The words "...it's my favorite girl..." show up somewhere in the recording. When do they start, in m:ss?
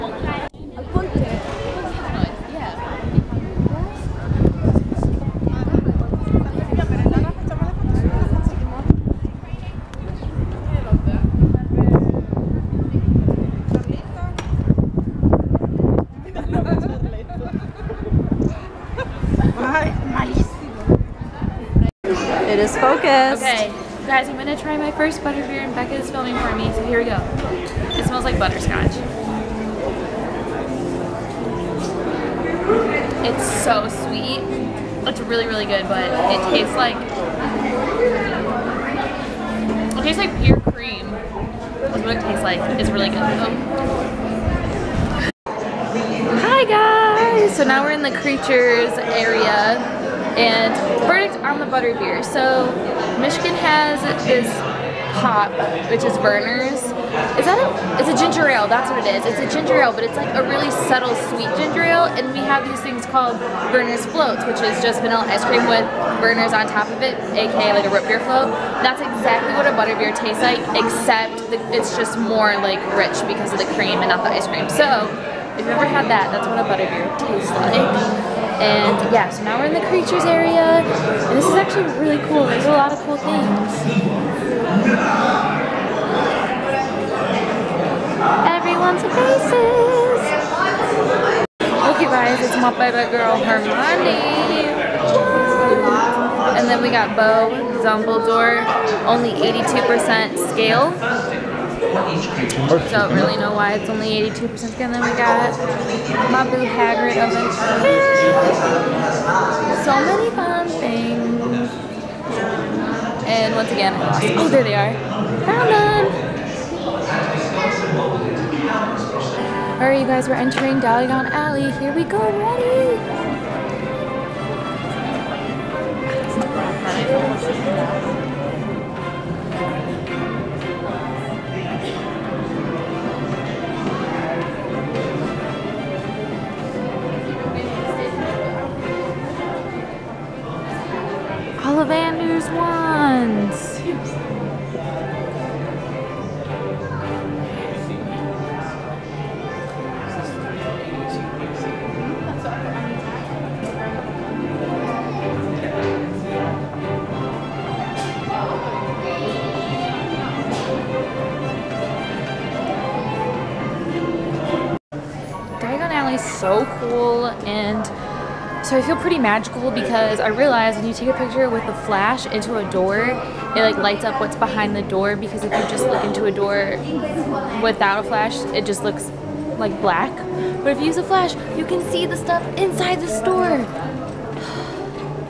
1:32.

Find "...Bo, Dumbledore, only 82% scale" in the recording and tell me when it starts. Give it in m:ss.
1:37.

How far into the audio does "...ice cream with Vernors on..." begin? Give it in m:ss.
1:05.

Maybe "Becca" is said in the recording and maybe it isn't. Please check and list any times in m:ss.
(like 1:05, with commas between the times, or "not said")
0:25.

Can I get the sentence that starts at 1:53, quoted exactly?
And once again, Oh, there they are.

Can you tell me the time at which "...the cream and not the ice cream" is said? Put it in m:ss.
1:13.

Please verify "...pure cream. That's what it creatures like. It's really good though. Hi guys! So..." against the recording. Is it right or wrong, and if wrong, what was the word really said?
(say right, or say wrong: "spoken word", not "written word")
wrong: "tastes", not "creatures".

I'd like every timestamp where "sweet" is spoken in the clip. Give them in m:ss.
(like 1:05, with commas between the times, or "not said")
0:34, 1:01.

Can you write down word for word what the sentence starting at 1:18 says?
And yeah, so now we're in the creatures area, and this is actually really cool.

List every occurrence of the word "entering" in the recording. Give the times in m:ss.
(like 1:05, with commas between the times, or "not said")
2:00.